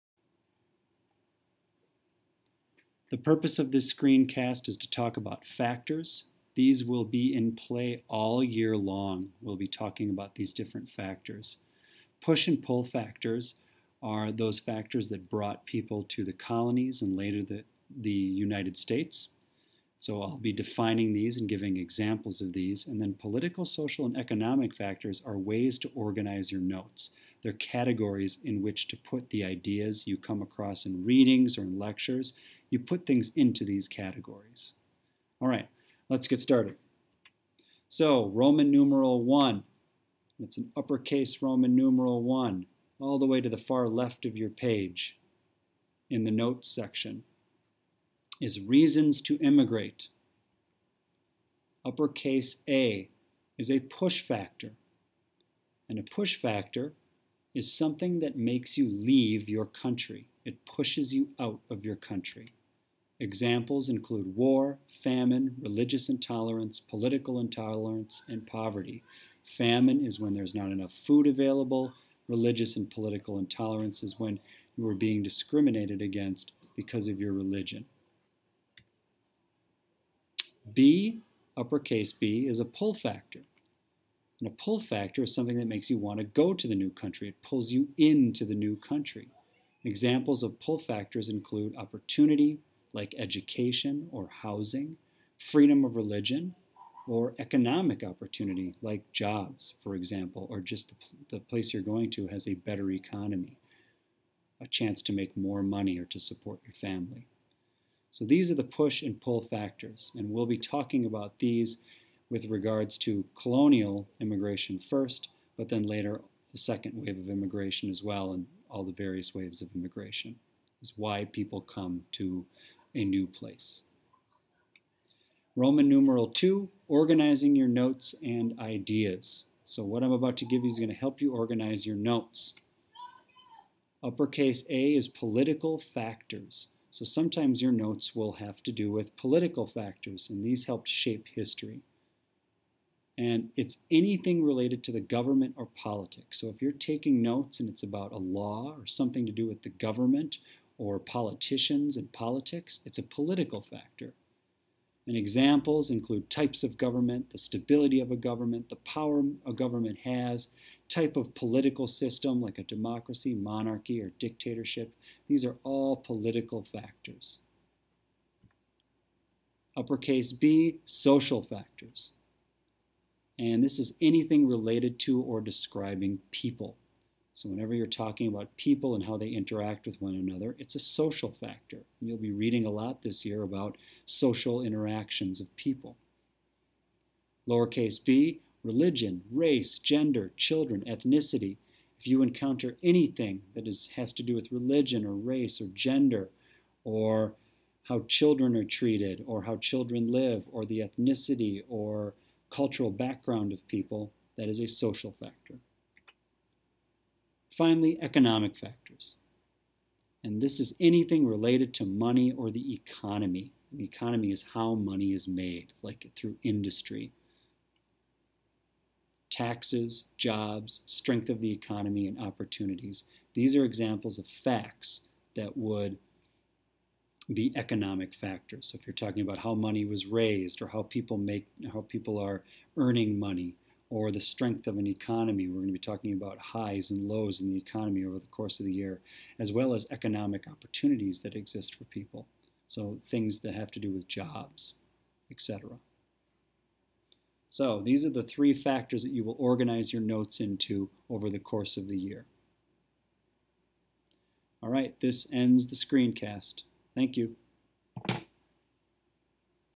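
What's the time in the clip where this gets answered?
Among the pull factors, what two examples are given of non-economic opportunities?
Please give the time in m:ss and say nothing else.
1:33.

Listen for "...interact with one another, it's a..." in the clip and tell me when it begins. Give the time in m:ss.
2:59.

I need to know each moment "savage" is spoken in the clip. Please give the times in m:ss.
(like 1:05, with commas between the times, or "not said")
not said.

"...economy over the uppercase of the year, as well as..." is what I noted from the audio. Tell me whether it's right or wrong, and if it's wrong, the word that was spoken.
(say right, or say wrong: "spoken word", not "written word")
wrong: "course", not "uppercase".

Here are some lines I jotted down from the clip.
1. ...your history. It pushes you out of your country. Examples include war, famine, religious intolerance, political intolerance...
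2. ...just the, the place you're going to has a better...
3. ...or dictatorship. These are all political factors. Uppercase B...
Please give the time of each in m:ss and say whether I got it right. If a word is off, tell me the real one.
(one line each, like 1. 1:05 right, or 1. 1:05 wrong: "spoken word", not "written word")
1. 0:59 wrong: "country", not "history"
2. 1:40 right
3. 2:44 right.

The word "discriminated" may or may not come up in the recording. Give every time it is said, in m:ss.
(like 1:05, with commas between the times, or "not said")
1:15.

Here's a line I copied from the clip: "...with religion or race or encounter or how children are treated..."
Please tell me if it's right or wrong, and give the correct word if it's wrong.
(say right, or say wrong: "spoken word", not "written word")
wrong: "gender", not "encounter".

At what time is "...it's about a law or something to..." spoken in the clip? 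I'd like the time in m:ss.
2:27.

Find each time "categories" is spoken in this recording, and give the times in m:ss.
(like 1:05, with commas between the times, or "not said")
0:27, 0:33.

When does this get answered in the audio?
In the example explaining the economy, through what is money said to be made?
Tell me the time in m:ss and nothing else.
3:36.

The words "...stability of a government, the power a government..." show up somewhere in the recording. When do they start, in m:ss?
2:37.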